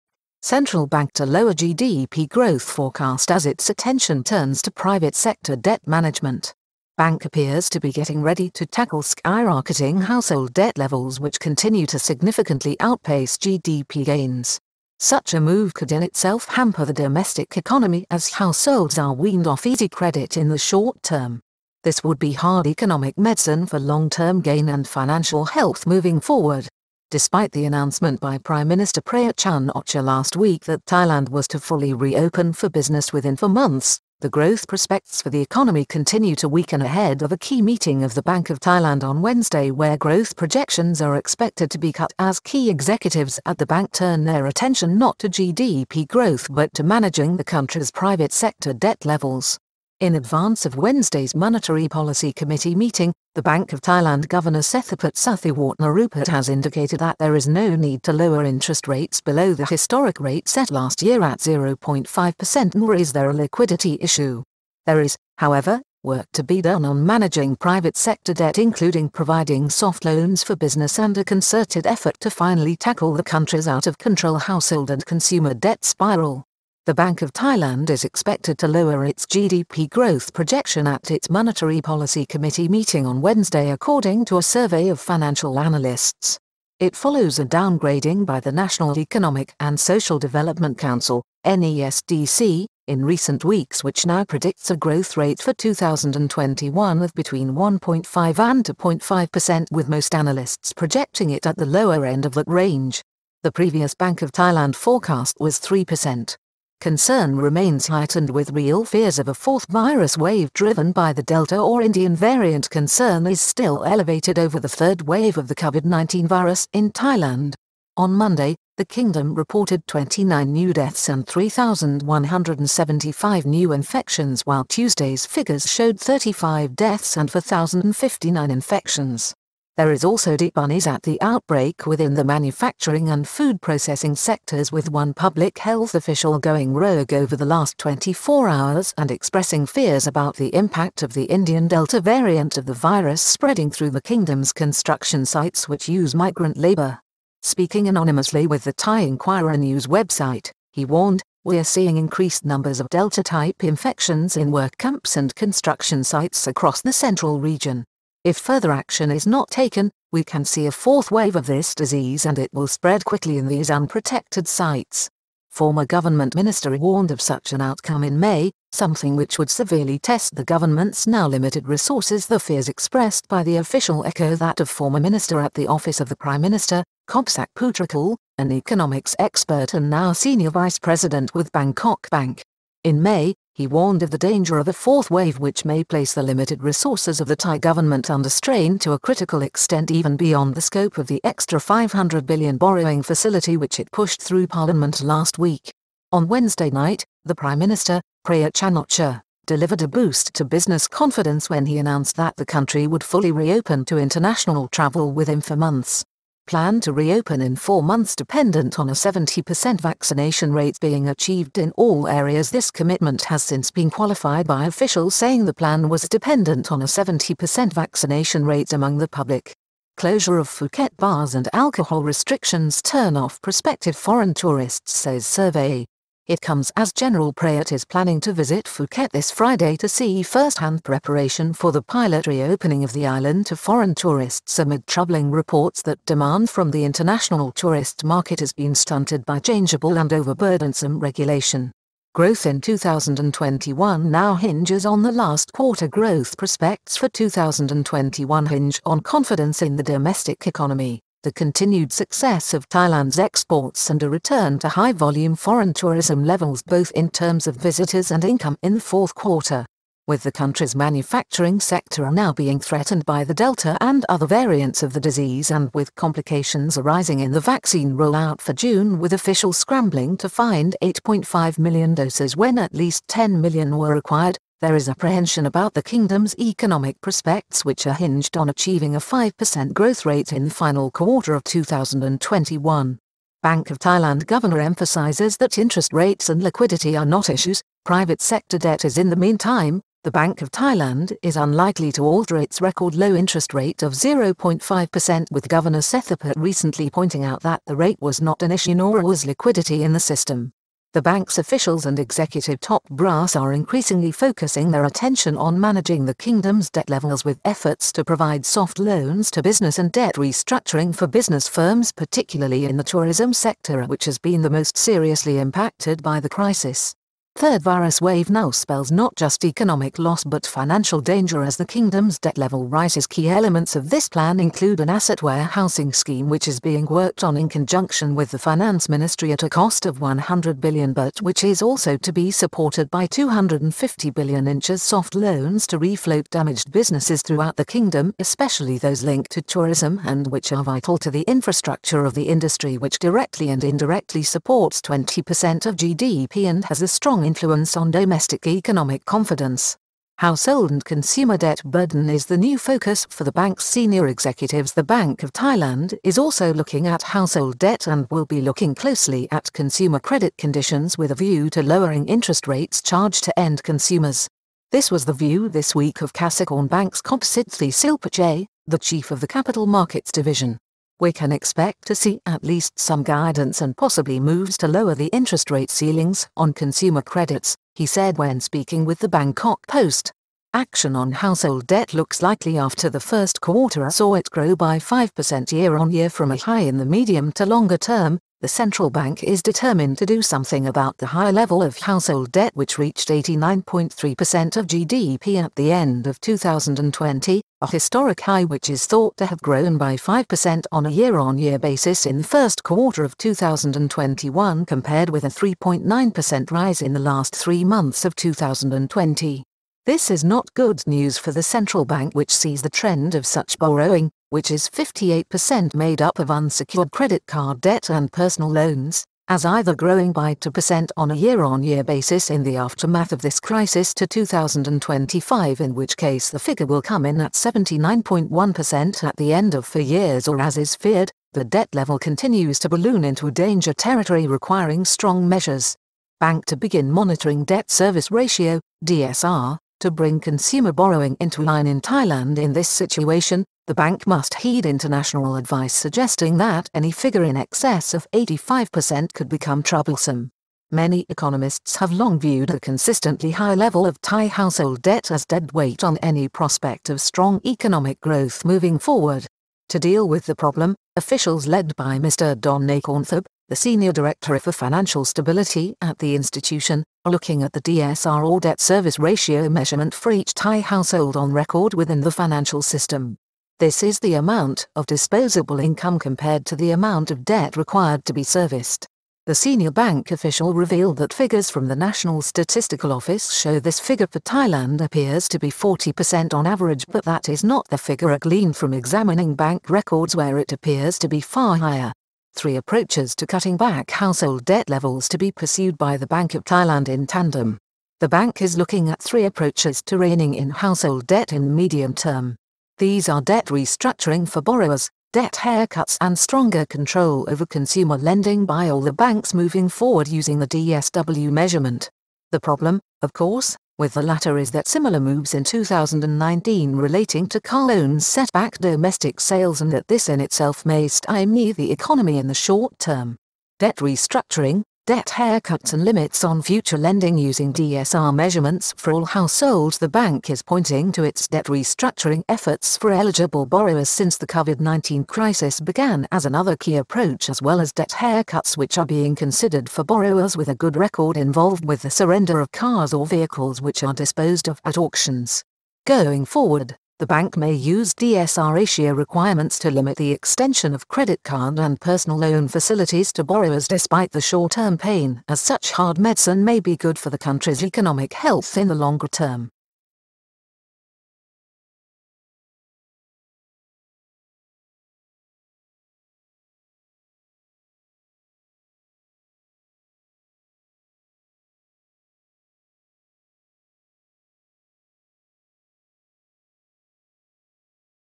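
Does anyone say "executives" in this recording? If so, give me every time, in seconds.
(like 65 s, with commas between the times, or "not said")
42 s, 301 s, 354 s.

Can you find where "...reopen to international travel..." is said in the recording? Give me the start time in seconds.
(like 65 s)
203 s.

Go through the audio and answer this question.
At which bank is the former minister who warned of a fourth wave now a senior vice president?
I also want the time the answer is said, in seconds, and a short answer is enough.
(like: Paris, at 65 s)
Bangkok Bank, at 181 s.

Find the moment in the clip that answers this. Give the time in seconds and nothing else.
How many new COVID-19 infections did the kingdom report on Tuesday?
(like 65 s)
127 s.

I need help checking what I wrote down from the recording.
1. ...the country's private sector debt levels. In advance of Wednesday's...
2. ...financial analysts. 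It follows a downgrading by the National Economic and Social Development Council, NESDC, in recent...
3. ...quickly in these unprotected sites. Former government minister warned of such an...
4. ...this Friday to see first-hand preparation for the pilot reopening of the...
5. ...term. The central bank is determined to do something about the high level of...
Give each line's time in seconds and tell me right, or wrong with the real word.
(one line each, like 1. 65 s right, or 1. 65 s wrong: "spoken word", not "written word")
1. 47 s right
2. 84 s right
3. 163 s right
4. 229 s right
5. 387 s right.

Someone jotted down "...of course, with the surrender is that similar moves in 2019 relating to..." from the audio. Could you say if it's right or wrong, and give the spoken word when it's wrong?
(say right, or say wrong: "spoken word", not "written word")
wrong: "latter", not "surrender".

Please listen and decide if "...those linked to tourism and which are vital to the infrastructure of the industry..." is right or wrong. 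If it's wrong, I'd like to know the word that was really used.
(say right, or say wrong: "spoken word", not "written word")
right.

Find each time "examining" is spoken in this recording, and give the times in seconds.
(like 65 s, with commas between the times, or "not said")
488 s.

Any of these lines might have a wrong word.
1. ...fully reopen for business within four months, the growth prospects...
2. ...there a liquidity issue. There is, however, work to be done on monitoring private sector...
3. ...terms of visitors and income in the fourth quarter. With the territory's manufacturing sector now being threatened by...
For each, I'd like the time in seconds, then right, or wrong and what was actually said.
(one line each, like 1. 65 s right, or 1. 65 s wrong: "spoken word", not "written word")
1. 31 s right
2. 63 s wrong: "managing", not "monitoring"
3. 257 s wrong: "country", not "territory".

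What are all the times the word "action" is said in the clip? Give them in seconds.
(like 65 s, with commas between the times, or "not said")
158 s, 380 s.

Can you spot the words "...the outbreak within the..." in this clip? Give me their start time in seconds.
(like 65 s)
131 s.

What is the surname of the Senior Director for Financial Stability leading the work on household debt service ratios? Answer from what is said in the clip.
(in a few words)
Nakornthab.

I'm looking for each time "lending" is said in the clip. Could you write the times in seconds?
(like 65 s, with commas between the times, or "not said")
507 s, 526 s.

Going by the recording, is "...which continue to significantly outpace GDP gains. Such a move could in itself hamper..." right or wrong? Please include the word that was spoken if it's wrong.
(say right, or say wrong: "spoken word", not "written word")
right.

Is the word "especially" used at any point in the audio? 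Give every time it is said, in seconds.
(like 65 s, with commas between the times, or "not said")
338 s.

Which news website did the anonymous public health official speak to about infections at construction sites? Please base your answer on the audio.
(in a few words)
Thai Inquirer.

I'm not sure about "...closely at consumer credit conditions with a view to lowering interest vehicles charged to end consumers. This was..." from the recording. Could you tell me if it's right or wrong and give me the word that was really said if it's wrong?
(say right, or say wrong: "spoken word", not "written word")
wrong: "rates", not "vehicles".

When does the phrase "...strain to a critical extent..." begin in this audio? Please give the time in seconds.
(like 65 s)
188 s.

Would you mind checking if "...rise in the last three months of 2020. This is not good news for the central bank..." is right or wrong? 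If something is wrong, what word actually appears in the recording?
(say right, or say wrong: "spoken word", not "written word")
right.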